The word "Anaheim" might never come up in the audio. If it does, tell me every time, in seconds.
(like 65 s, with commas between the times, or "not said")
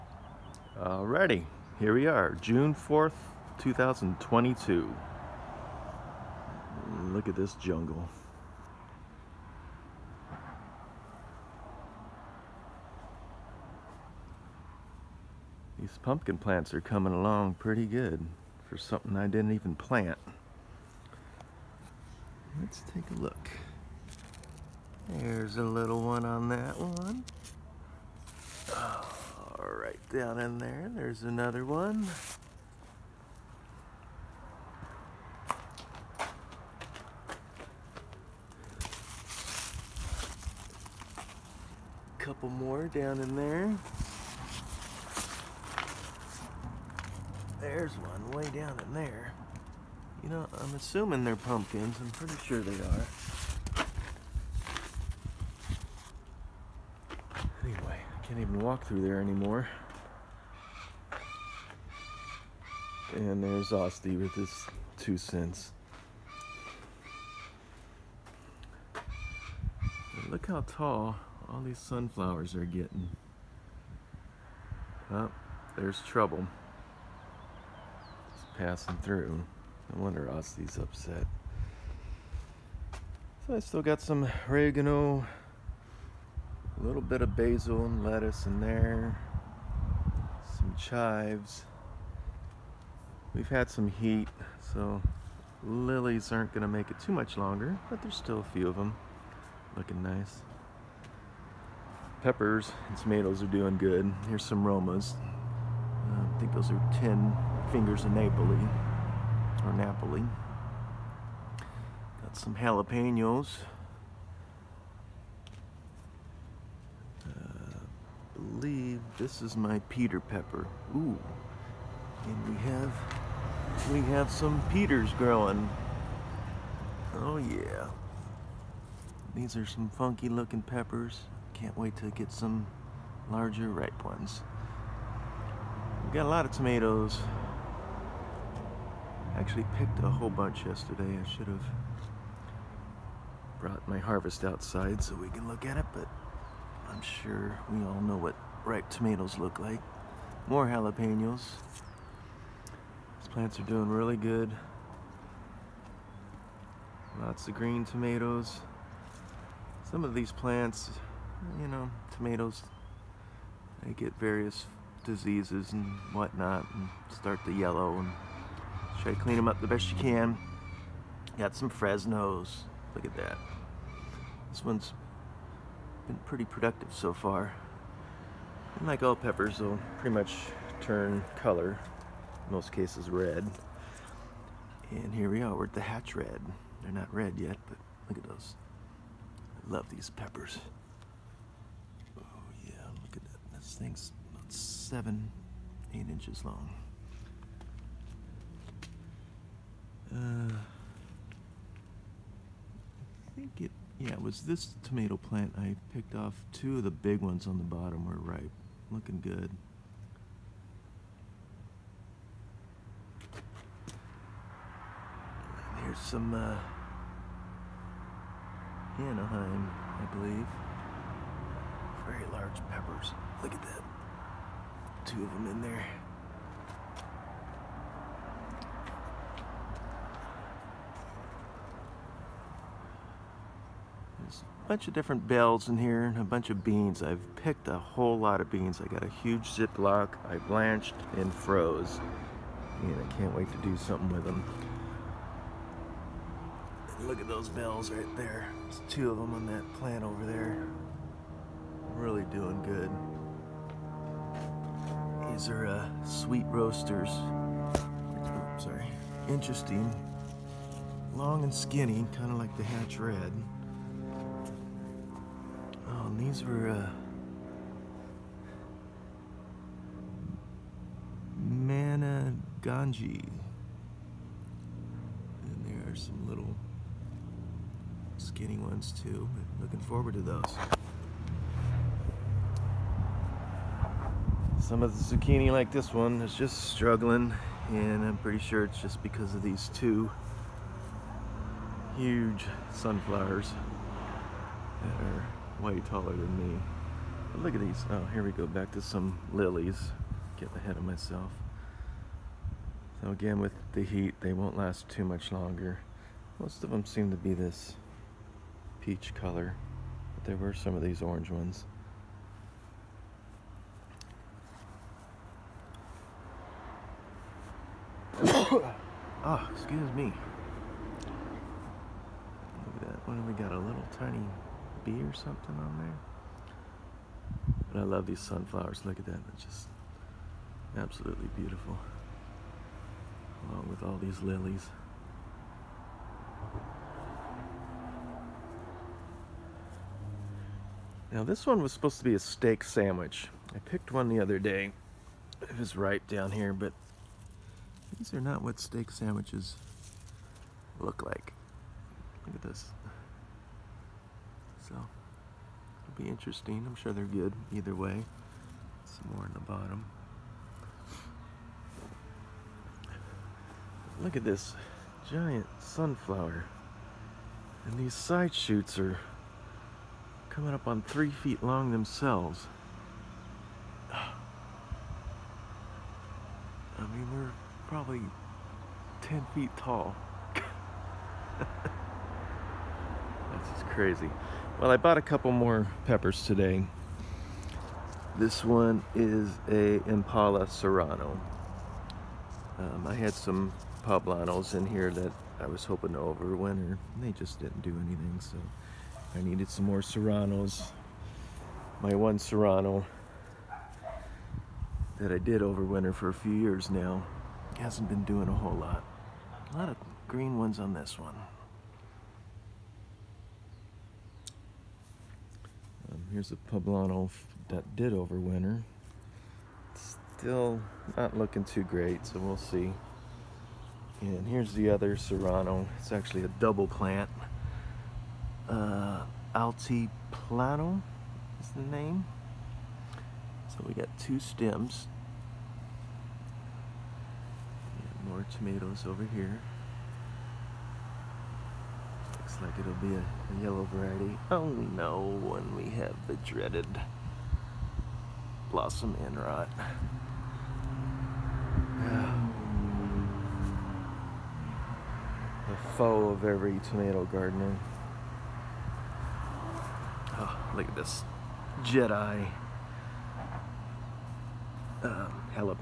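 218 s.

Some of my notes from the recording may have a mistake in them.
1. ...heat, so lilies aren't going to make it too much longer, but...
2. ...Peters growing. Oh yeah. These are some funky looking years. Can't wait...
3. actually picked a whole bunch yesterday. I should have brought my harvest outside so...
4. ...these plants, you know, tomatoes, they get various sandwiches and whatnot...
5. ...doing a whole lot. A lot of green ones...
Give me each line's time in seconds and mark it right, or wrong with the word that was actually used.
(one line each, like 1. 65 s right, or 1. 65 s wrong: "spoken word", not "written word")
1. 93 s right
2. 124 s wrong: "peppers", not "years"
3. 139 s right
4. 160 s wrong: "diseases", not "sandwiches"
5. 408 s right.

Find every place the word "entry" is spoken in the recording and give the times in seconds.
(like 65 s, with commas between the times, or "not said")
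not said.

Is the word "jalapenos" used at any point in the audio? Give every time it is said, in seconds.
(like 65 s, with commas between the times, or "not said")
112 s, 150 s.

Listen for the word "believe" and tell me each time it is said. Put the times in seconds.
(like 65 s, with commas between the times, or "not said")
118 s, 220 s.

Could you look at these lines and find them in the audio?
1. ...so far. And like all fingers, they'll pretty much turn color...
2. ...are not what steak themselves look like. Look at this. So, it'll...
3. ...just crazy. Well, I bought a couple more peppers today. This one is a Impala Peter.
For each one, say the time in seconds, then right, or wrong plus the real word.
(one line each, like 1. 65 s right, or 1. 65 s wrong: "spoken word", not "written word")
1. 176 s wrong: "peppers", not "fingers"
2. 348 s wrong: "sandwiches", not "themselves"
3. 383 s wrong: "Serrano", not "Peter".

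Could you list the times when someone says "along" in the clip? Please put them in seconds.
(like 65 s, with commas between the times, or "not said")
17 s, 333 s.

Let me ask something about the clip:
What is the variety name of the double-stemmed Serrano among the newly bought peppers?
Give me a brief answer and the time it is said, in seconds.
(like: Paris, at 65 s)
Altiplano, at 429 s.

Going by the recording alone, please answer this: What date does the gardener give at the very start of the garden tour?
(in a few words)
June 4th, 2022.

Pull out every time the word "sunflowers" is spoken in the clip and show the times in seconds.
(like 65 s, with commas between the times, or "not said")
71 s, 292 s, 328 s, 365 s.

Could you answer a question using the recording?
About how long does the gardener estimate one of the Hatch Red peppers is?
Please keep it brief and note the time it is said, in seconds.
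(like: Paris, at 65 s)
7 or 8 inches, at 194 s.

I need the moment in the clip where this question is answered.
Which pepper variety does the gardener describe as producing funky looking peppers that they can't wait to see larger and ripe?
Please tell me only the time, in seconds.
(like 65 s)
119 s.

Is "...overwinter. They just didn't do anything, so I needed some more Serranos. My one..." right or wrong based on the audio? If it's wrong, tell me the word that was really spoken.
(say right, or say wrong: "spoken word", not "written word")
right.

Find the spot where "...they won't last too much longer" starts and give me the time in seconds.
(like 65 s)
304 s.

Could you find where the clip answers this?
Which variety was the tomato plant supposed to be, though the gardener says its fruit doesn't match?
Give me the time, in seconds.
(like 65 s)
342 s.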